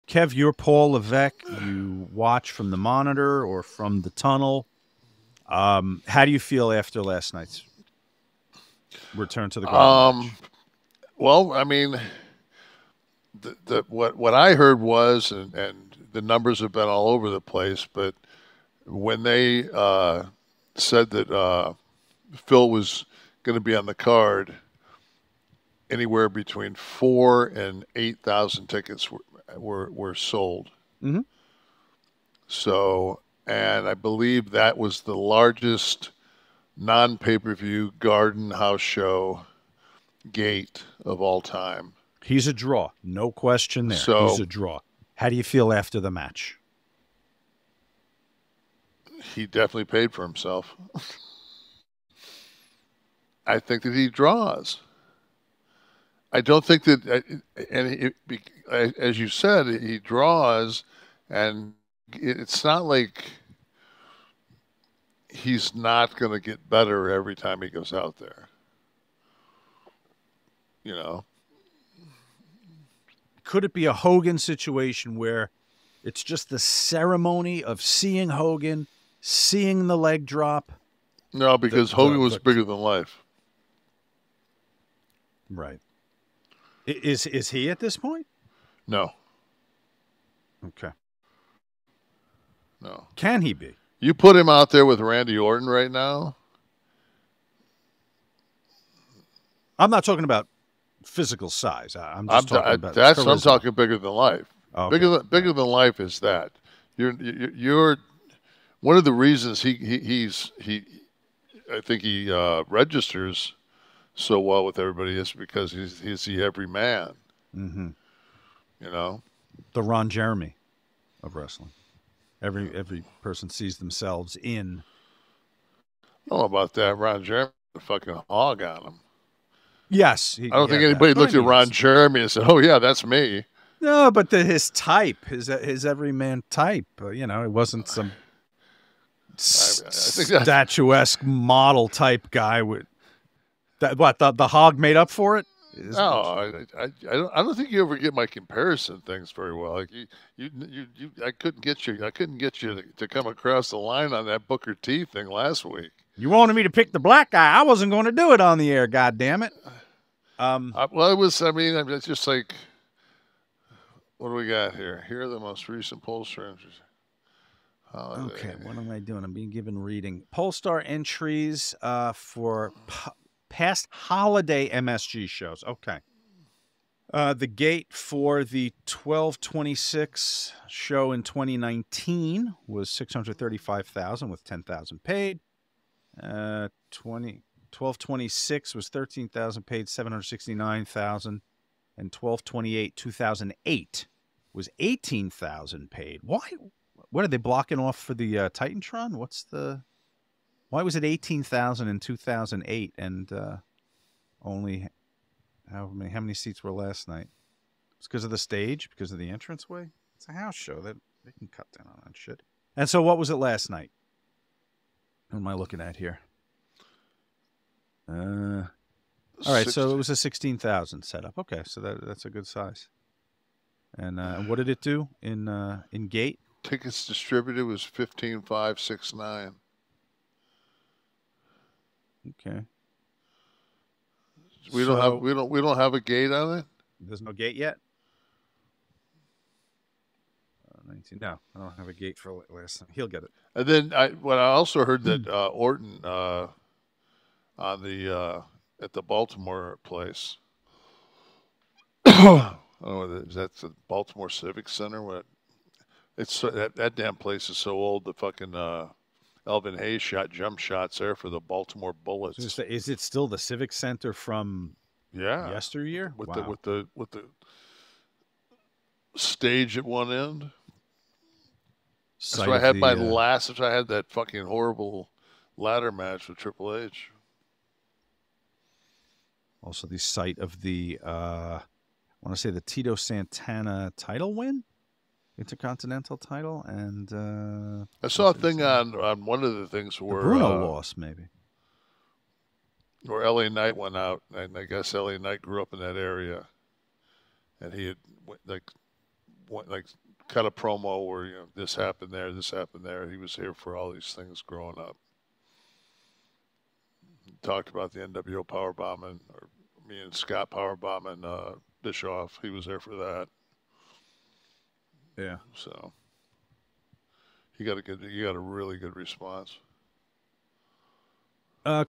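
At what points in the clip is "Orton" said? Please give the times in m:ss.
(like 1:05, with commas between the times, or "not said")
1:35, 4:05.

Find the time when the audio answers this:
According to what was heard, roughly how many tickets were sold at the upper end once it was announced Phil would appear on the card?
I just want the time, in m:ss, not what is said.
0:27.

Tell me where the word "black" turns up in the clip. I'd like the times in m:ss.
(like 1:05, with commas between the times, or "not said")
2:36.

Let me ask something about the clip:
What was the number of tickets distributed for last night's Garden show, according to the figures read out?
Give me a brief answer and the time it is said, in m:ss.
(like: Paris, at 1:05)
15,569, at 3:47.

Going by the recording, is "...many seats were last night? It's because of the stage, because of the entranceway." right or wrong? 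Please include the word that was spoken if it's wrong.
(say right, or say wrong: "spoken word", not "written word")
right.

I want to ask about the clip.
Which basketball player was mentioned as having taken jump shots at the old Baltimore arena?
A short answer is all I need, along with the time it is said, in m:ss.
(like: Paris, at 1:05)
Elvin Hayes, at 4:19.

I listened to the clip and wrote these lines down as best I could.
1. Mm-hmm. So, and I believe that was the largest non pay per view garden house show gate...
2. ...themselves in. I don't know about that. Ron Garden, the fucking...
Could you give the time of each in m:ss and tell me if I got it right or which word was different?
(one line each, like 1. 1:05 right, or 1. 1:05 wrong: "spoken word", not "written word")
1. 0:31 right
2. 2:03 wrong: "Jeremy", not "Garden".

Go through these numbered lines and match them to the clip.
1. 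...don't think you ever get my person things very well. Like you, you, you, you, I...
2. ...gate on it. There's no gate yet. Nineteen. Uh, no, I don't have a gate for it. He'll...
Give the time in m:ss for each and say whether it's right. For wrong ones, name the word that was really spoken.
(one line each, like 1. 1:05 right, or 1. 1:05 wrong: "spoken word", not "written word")
1. 2:27 wrong: "comparison", not "person"
2. 3:56 right.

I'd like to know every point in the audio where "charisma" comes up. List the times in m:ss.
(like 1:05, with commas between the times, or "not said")
1:43.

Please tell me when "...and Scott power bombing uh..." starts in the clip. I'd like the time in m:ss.
5:10.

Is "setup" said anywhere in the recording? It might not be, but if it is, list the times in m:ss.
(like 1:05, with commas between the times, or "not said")
3:41.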